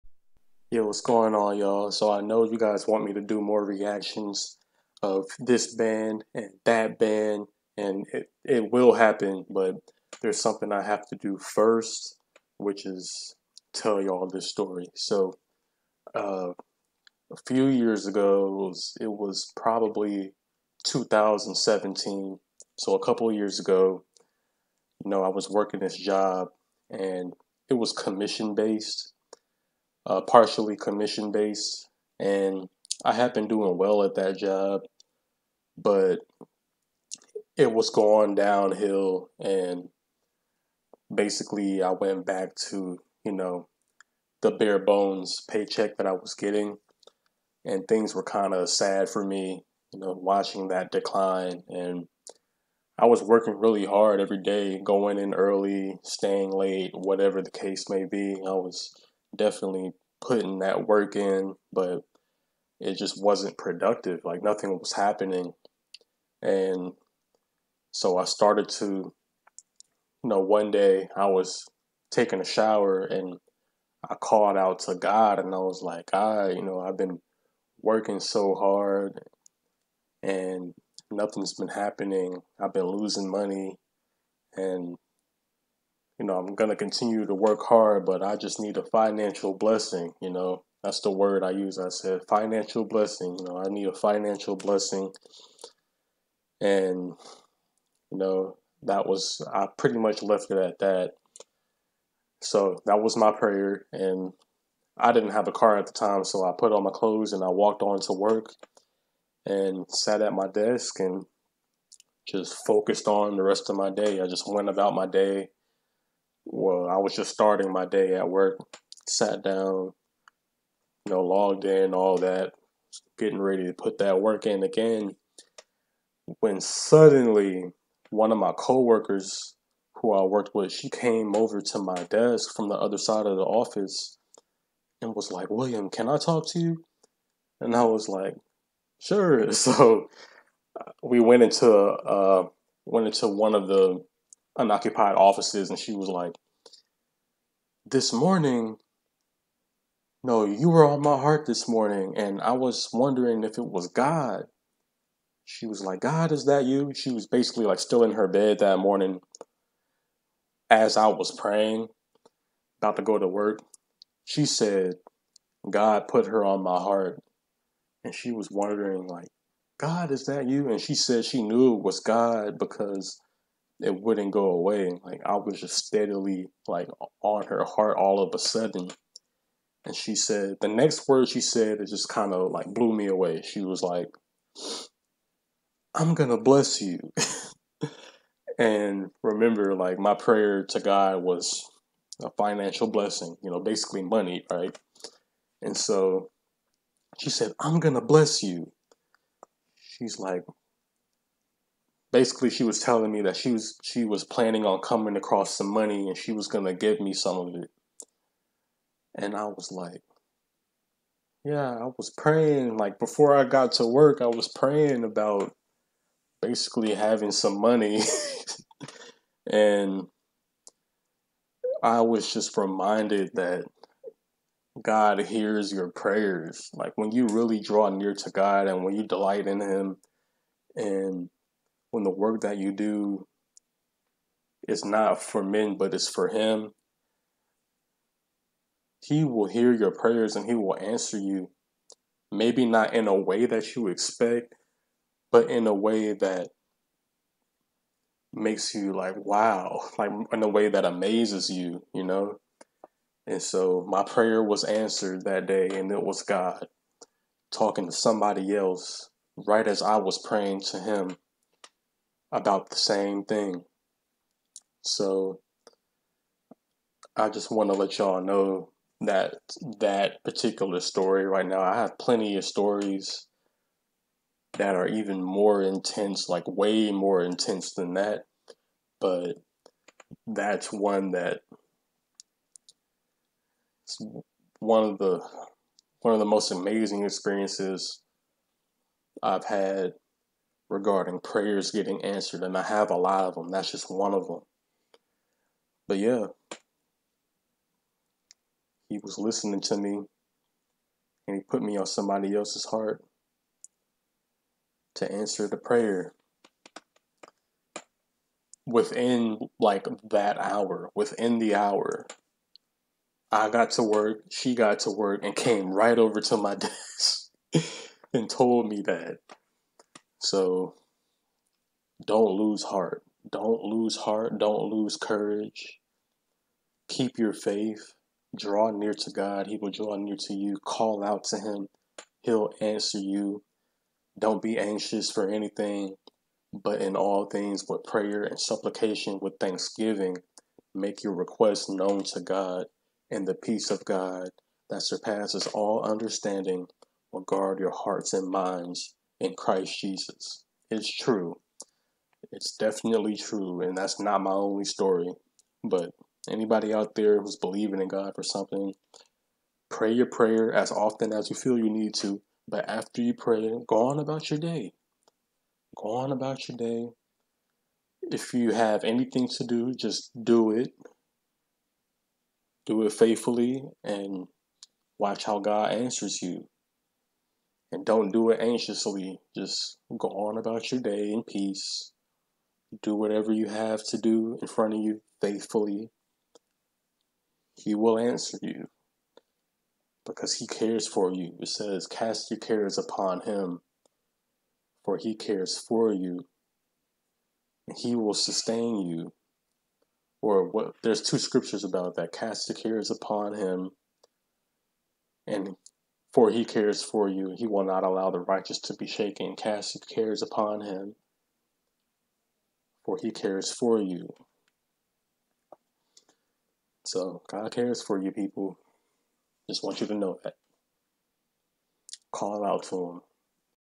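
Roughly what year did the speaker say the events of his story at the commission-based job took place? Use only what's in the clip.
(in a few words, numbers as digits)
2017.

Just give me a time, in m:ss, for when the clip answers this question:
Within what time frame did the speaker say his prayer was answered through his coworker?
5:10.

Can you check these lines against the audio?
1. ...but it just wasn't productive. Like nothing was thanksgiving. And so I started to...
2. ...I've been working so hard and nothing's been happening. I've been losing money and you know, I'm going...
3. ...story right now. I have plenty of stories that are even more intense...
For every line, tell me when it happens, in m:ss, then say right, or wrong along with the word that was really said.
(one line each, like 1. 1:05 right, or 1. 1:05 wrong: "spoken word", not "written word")
1. 1:01 wrong: "happening", not "thanksgiving"
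2. 1:16 right
3. 4:30 right.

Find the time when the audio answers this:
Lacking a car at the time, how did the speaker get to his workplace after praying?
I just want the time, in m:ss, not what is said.
1:47.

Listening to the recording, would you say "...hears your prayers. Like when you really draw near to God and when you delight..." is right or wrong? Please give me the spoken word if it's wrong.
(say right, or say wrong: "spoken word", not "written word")
right.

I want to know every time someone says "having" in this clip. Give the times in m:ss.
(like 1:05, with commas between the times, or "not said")
3:36.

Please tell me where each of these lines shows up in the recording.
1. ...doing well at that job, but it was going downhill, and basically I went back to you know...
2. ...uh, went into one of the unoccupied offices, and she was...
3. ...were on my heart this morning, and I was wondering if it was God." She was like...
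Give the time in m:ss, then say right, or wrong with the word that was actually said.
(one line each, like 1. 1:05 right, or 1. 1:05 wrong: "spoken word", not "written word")
1. 0:33 right
2. 2:21 right
3. 2:30 right.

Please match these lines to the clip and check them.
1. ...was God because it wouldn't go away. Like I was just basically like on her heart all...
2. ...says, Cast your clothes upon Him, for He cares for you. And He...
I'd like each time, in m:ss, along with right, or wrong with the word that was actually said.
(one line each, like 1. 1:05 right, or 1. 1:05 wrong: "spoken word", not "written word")
1. 2:51 wrong: "steadily", not "basically"
2. 6:31 wrong: "cares", not "clothes".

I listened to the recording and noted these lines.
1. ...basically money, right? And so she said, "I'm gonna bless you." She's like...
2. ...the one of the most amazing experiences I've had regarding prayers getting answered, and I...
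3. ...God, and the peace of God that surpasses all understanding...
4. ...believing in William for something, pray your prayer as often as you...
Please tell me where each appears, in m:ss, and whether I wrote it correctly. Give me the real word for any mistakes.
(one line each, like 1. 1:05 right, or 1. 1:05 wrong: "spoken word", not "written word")
1. 3:13 right
2. 4:44 right
3. 5:42 right
4. 5:57 wrong: "God", not "William".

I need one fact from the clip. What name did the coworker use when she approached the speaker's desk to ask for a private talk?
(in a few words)
William.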